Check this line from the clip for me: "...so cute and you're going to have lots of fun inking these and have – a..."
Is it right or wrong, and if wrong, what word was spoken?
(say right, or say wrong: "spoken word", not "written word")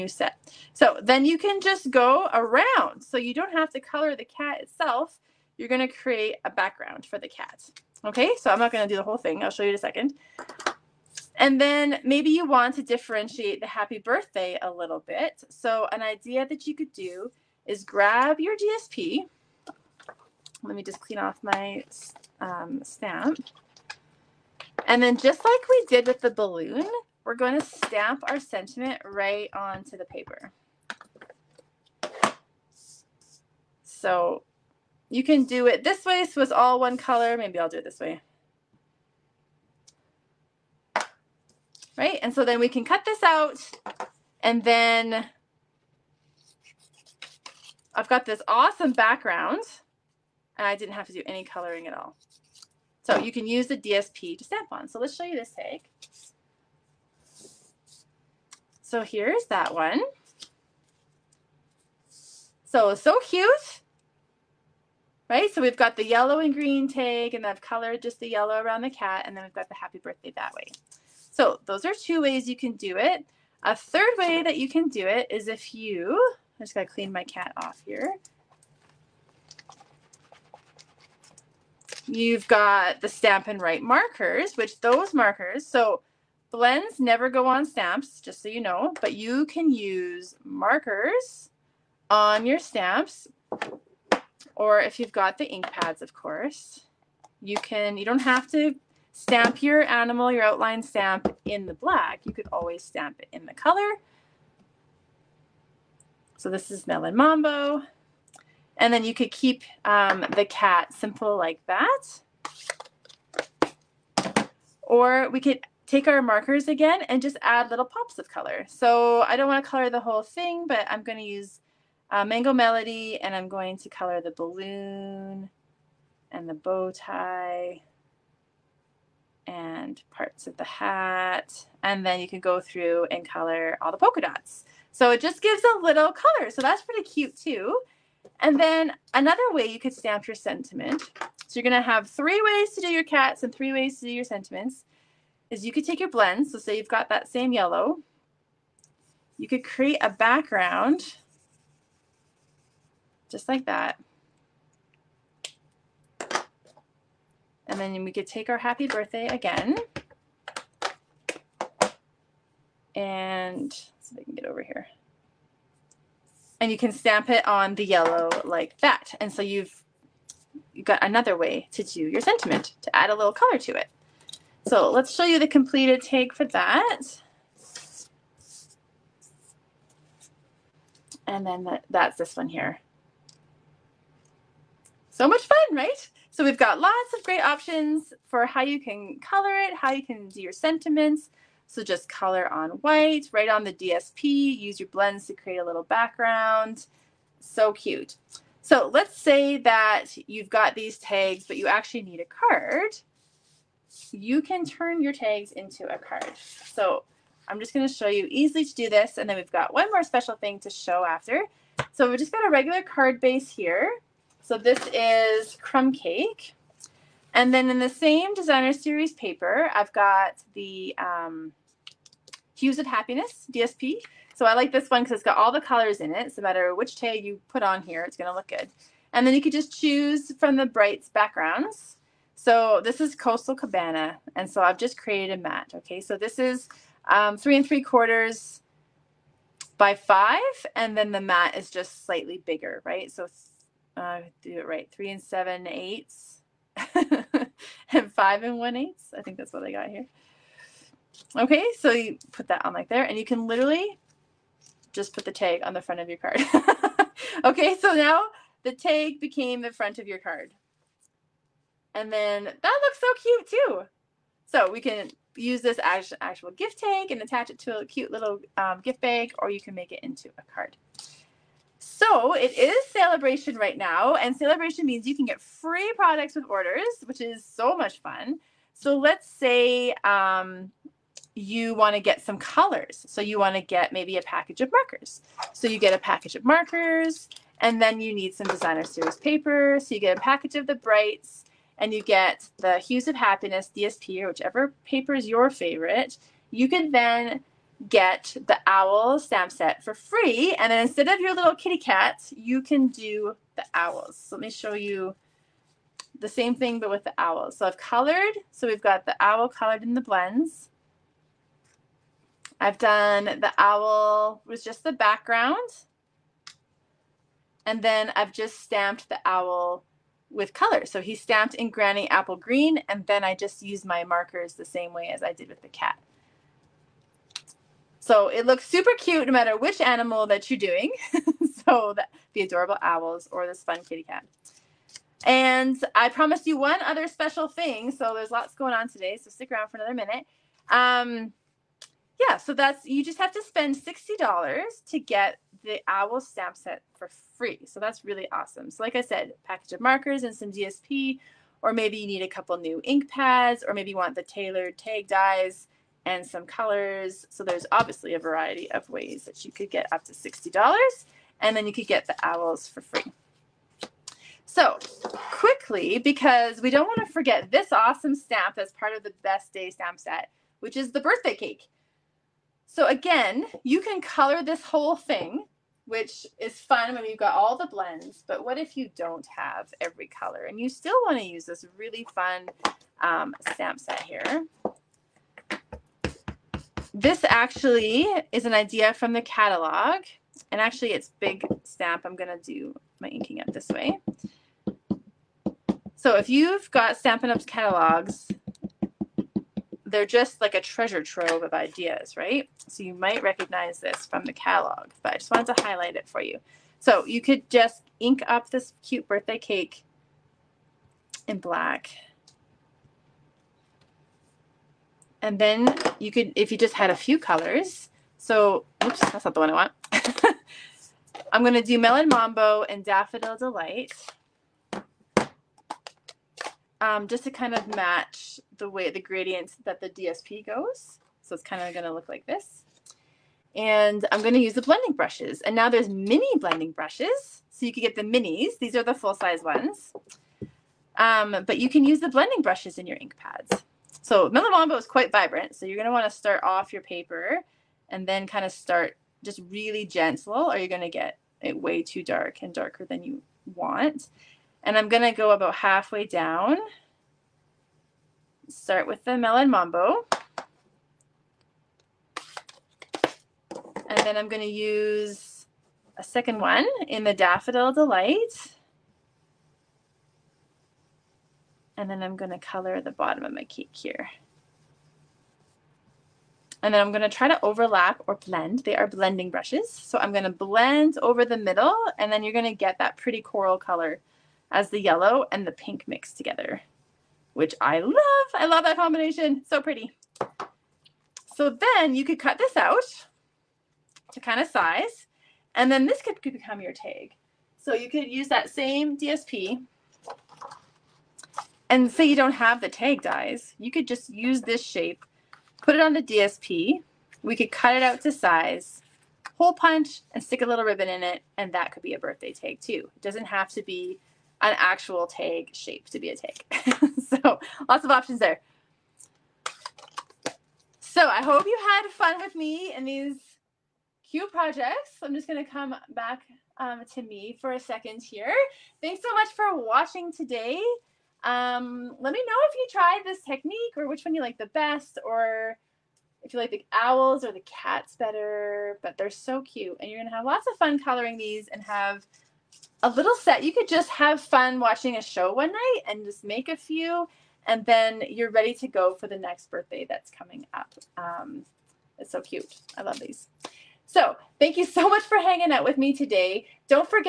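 wrong: "coloring", not "inking".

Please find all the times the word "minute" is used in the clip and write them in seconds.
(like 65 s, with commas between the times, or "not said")
339 s.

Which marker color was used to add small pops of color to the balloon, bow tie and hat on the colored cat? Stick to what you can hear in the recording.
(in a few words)
Mango Melody.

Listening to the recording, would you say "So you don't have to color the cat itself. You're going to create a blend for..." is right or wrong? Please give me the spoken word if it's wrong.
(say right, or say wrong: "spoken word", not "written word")
wrong: "background", not "blend".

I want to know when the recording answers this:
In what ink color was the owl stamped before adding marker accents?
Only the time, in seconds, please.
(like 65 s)
321 s.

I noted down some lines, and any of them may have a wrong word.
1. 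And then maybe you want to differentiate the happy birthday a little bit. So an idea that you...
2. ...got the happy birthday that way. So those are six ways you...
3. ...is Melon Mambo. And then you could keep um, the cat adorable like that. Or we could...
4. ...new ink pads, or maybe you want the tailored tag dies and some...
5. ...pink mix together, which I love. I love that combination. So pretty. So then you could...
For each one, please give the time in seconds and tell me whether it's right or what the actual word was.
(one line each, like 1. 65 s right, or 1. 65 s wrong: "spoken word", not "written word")
1. 11 s right
2. 69 s wrong: "two", not "six"
3. 106 s wrong: "simple", not "adorable"
4. 352 s right
5. 485 s right.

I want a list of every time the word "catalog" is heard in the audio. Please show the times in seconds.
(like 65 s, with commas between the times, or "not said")
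389 s, 397 s, 404 s.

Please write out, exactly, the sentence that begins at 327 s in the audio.
So it looks super cute no matter which animal that you're doing.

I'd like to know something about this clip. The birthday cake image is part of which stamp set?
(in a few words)
Best Day.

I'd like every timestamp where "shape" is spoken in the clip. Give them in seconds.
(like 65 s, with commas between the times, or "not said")
504 s, 515 s.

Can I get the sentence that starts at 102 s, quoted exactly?
You could always stamp it in the color.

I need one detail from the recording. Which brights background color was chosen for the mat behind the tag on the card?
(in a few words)
Coastal Cabana.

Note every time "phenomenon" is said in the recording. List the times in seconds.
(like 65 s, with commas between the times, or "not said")
not said.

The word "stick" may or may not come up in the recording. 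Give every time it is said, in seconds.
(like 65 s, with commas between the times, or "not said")
339 s, 510 s.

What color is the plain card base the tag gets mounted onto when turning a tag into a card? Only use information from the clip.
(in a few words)
Crumb Cake.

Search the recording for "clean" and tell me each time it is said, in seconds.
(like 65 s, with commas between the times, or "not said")
20 s, 76 s.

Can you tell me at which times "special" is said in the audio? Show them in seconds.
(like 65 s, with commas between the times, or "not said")
210 s, 337 s.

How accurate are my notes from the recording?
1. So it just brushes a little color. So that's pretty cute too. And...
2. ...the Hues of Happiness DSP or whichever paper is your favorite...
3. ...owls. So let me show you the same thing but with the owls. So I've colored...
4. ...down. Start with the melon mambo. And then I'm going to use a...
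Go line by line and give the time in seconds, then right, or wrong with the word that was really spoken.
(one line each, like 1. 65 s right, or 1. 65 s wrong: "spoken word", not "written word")
1. 134 s wrong: "gives", not "brushes"
2. 292 s right
3. 303 s right
4. 456 s right.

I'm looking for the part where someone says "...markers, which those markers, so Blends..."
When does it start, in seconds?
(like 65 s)
83 s.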